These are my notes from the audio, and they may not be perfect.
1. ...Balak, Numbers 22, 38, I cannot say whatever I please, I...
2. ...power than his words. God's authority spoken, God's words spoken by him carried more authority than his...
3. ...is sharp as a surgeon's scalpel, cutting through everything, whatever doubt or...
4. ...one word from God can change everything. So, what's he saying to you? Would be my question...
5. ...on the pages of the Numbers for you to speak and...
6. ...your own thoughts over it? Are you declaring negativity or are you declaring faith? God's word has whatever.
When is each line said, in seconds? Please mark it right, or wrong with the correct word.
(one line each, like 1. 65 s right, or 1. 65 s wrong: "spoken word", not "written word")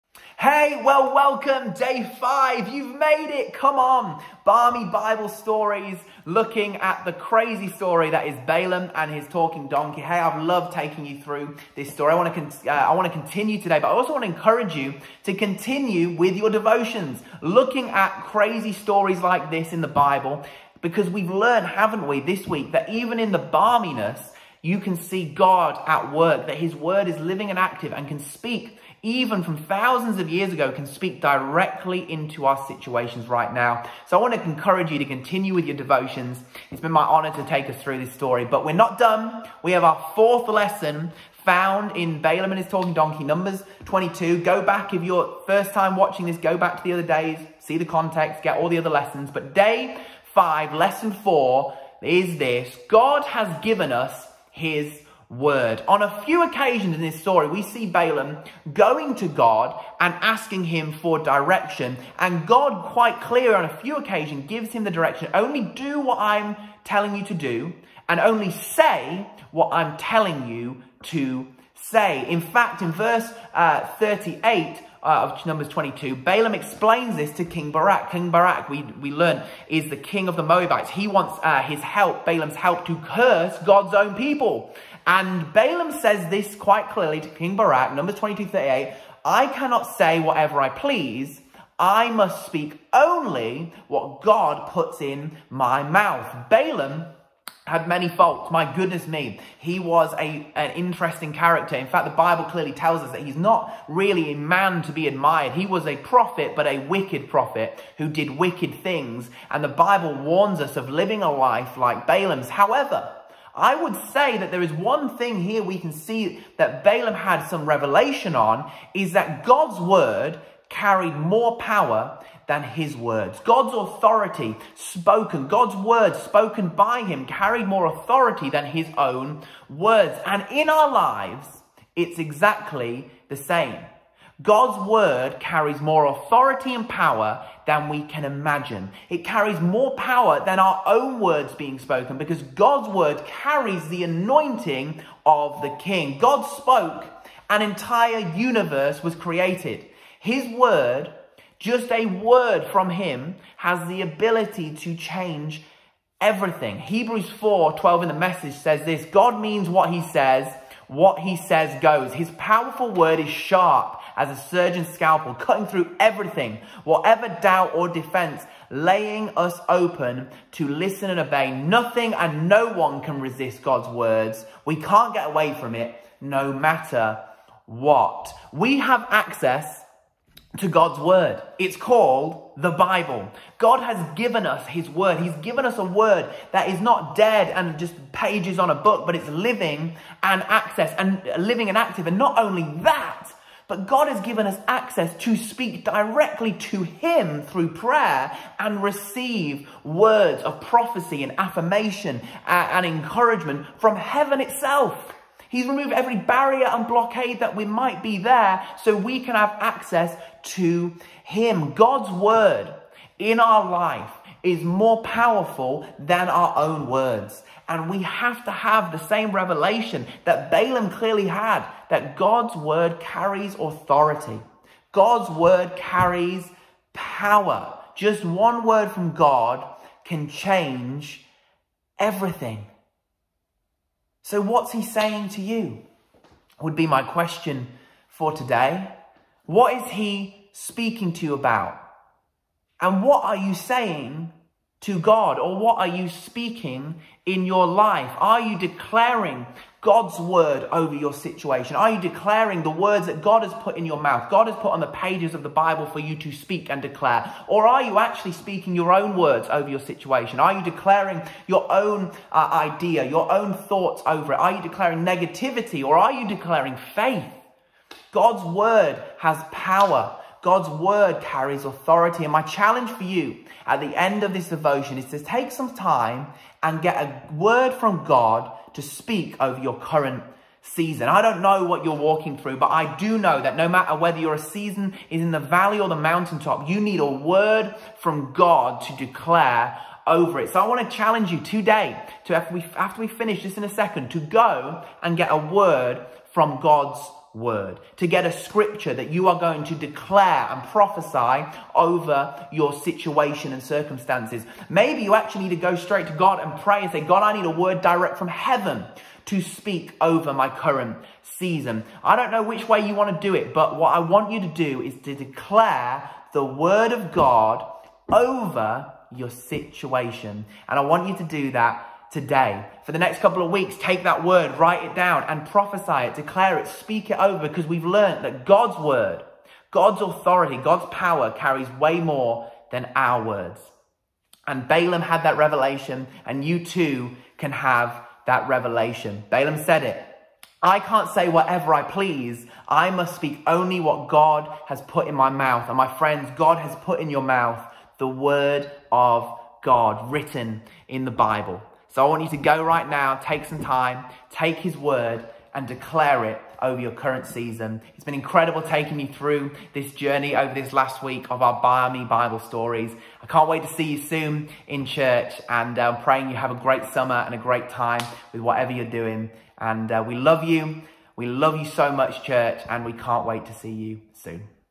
1. 87 s right
2. 121 s right
3. 163 s right
4. 228 s right
5. 254 s wrong: "Bible", not "Numbers"
6. 263 s wrong: "power", not "whatever".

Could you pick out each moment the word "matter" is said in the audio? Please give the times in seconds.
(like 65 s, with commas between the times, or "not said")
176 s, 283 s.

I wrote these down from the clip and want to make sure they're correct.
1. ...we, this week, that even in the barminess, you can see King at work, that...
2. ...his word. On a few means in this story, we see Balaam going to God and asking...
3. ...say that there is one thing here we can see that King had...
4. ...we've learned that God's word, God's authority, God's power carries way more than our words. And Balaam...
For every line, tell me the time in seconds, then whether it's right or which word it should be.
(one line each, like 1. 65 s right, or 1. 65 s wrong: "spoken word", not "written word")
1. 22 s wrong: "God", not "King"
2. 54 s wrong: "occasions", not "means"
3. 114 s wrong: "Balaam", not "King"
4. 327 s right.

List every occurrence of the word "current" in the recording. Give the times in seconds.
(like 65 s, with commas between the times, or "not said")
279 s, 310 s, 356 s.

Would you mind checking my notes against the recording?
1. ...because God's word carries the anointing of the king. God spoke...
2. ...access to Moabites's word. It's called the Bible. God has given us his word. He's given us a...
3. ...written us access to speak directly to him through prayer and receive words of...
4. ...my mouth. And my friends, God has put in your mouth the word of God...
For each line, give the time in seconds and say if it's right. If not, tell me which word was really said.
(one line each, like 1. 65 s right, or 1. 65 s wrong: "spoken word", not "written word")
1. 142 s right
2. 179 s wrong: "God", not "Moabites"
3. 194 s wrong: "given", not "written"
4. 345 s right.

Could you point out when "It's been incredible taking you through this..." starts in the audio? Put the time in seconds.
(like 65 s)
357 s.